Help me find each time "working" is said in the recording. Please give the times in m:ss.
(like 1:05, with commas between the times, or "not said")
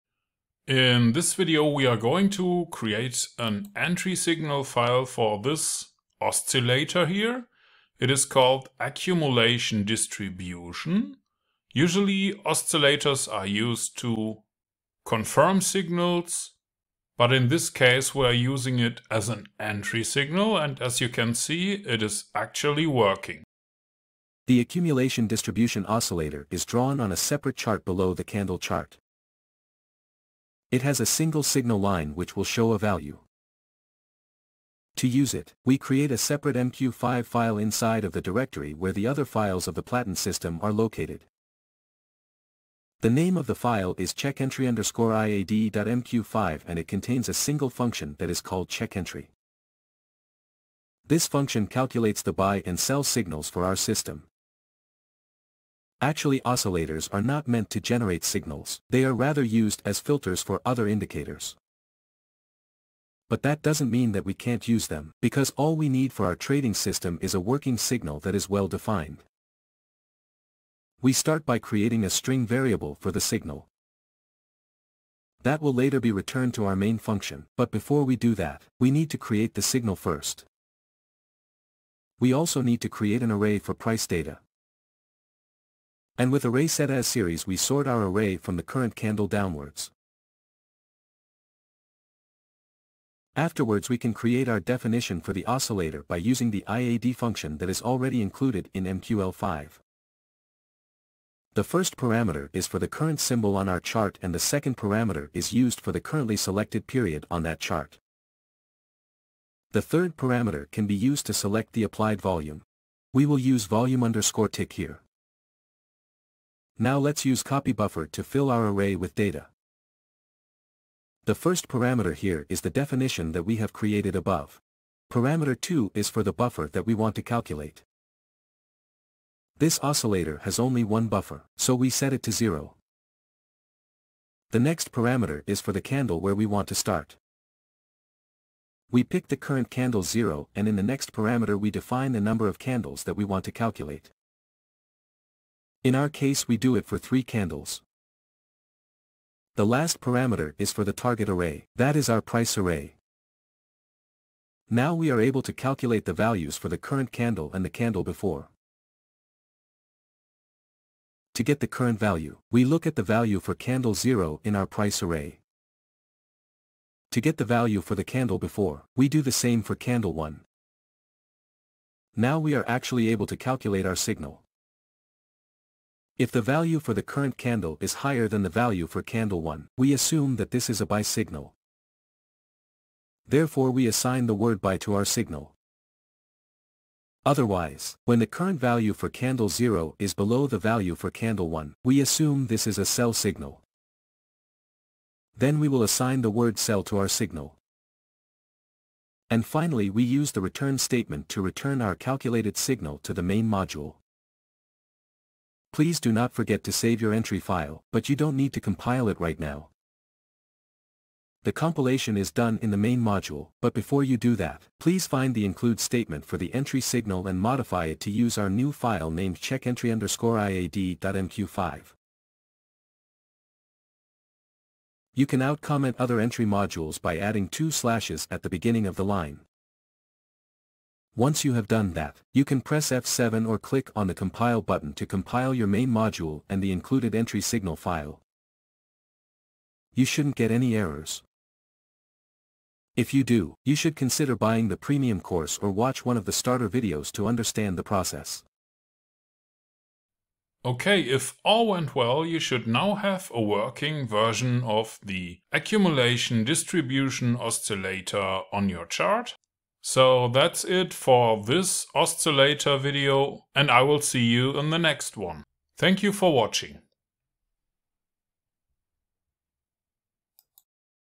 0:22, 1:07, 4:13.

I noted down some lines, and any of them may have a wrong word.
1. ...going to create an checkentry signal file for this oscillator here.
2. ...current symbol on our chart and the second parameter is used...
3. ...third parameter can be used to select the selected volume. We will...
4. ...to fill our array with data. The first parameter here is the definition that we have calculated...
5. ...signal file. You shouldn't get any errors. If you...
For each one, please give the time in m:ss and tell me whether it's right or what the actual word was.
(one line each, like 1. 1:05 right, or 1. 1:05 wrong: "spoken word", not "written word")
1. 0:01 wrong: "entry", not "checkentry"
2. 1:42 right
3. 1:49 wrong: "applied", not "selected"
4. 1:58 wrong: "created", not "calculated"
5. 3:57 right.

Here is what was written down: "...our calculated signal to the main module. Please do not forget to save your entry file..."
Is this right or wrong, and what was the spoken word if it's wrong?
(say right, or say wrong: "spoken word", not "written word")
right.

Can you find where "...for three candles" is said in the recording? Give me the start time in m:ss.
2:26.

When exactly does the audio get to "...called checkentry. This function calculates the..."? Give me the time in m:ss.
0:48.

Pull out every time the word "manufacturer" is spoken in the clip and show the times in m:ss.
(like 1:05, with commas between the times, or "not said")
not said.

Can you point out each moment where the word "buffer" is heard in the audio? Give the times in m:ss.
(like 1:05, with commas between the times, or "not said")
1:57, 2:06, 2:11.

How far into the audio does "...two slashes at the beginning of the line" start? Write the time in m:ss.
3:47.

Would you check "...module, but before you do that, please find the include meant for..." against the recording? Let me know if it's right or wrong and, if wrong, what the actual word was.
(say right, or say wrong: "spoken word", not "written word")
wrong: "statement", not "meant".